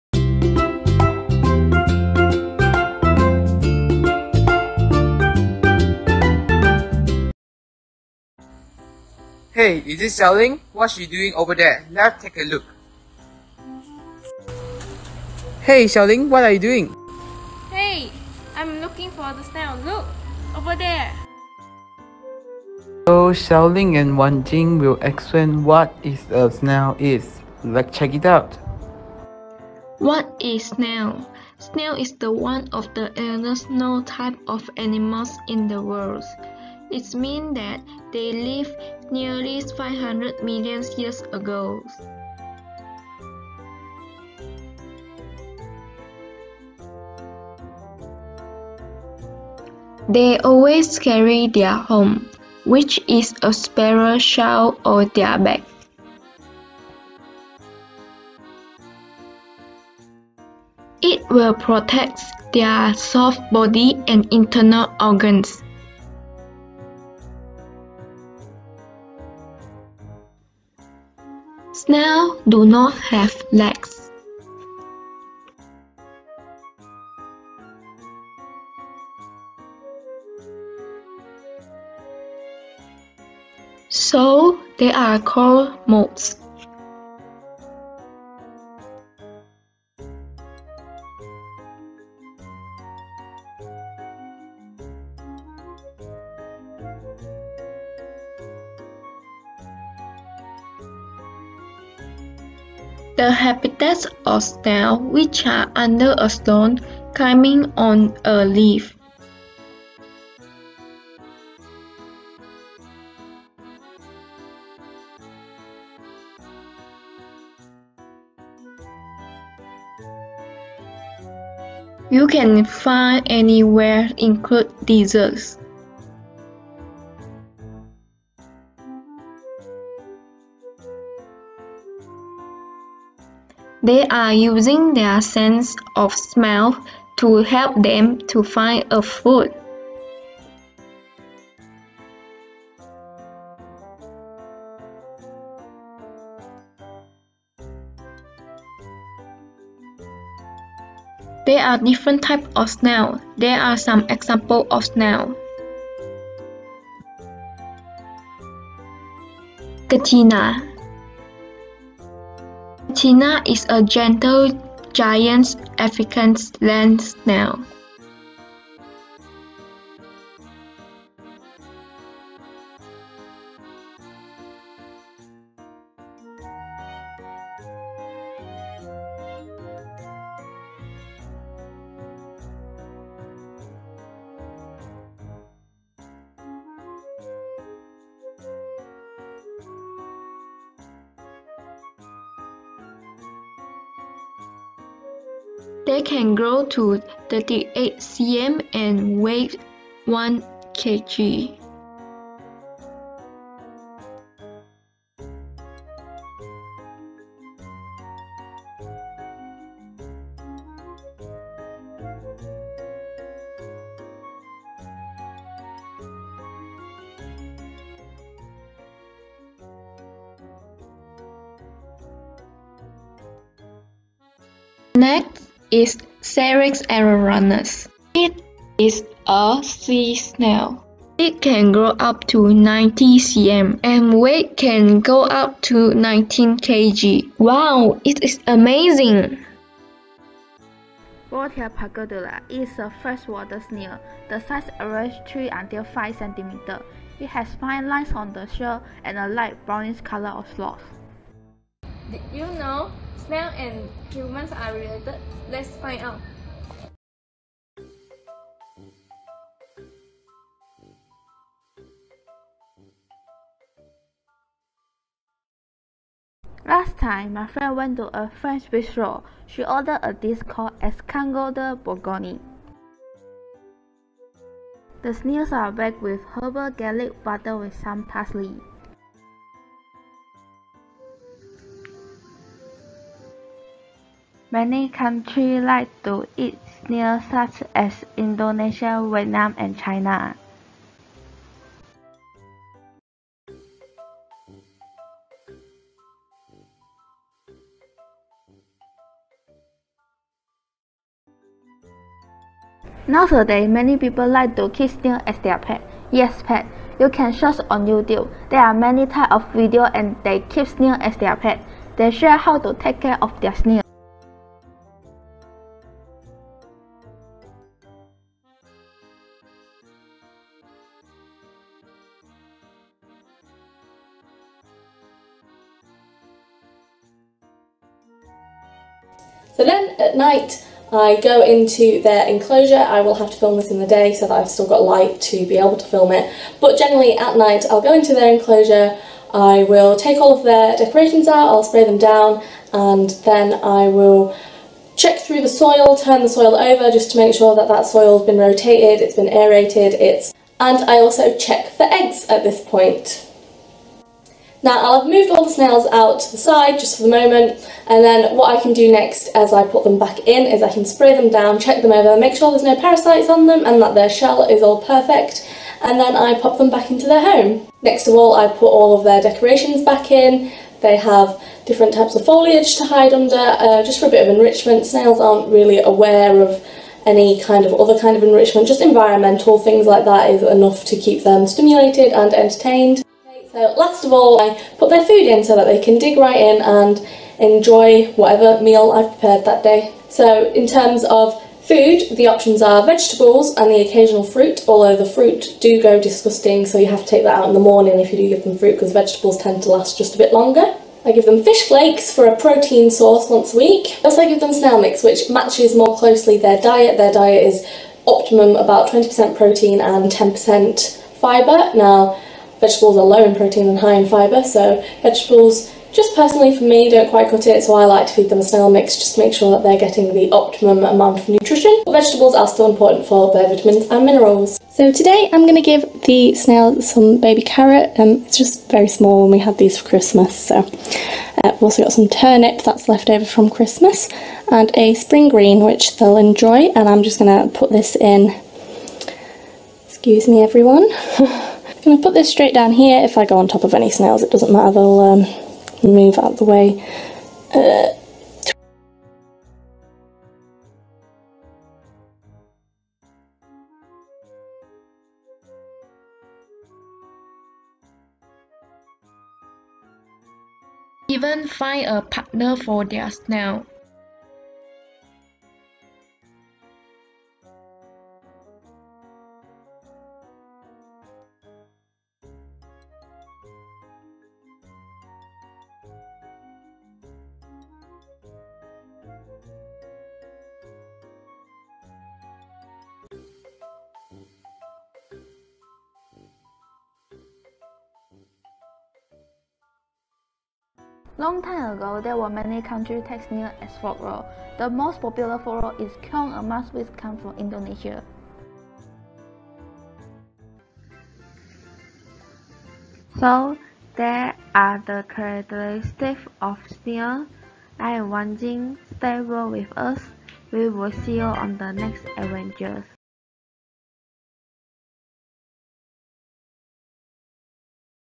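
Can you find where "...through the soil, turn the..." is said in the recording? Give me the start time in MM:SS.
05:45.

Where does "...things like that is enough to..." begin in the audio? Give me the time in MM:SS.
06:19.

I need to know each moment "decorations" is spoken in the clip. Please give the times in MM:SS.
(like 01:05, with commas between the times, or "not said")
05:40, 06:09.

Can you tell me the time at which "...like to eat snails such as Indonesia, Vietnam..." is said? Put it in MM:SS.
04:45.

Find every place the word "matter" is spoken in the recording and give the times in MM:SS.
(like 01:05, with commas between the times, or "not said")
07:24.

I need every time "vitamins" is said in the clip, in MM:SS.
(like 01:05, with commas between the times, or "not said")
07:03.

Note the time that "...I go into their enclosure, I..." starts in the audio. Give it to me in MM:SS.
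05:30.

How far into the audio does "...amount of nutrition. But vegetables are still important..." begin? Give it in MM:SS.
07:00.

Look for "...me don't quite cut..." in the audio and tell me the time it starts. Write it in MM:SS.
06:56.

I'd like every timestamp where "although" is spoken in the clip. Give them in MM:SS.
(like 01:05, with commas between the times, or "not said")
06:34.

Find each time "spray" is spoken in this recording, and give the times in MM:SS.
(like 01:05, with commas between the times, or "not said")
05:41, 06:00.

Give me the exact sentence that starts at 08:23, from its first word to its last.
So, there are the characteristics of snail.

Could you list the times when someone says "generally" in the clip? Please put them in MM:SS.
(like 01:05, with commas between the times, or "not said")
05:36.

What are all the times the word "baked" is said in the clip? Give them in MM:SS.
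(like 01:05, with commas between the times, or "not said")
04:35.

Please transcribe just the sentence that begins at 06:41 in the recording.
I give them fish flakes for a protein source once a week.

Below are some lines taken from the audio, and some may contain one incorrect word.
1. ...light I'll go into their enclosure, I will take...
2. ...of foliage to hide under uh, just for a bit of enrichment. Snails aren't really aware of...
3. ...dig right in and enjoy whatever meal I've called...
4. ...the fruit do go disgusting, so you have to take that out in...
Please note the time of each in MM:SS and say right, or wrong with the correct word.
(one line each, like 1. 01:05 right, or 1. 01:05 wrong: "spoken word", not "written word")
1. 05:37 wrong: "night", not "light"
2. 06:12 right
3. 06:25 wrong: "prepared", not "called"
4. 06:34 right.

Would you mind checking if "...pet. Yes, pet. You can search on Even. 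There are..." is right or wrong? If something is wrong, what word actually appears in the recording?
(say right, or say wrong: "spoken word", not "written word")
wrong: "YouTube", not "Even".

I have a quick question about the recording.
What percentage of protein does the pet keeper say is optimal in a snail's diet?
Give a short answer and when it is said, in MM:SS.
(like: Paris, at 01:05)
20%, at 06:48.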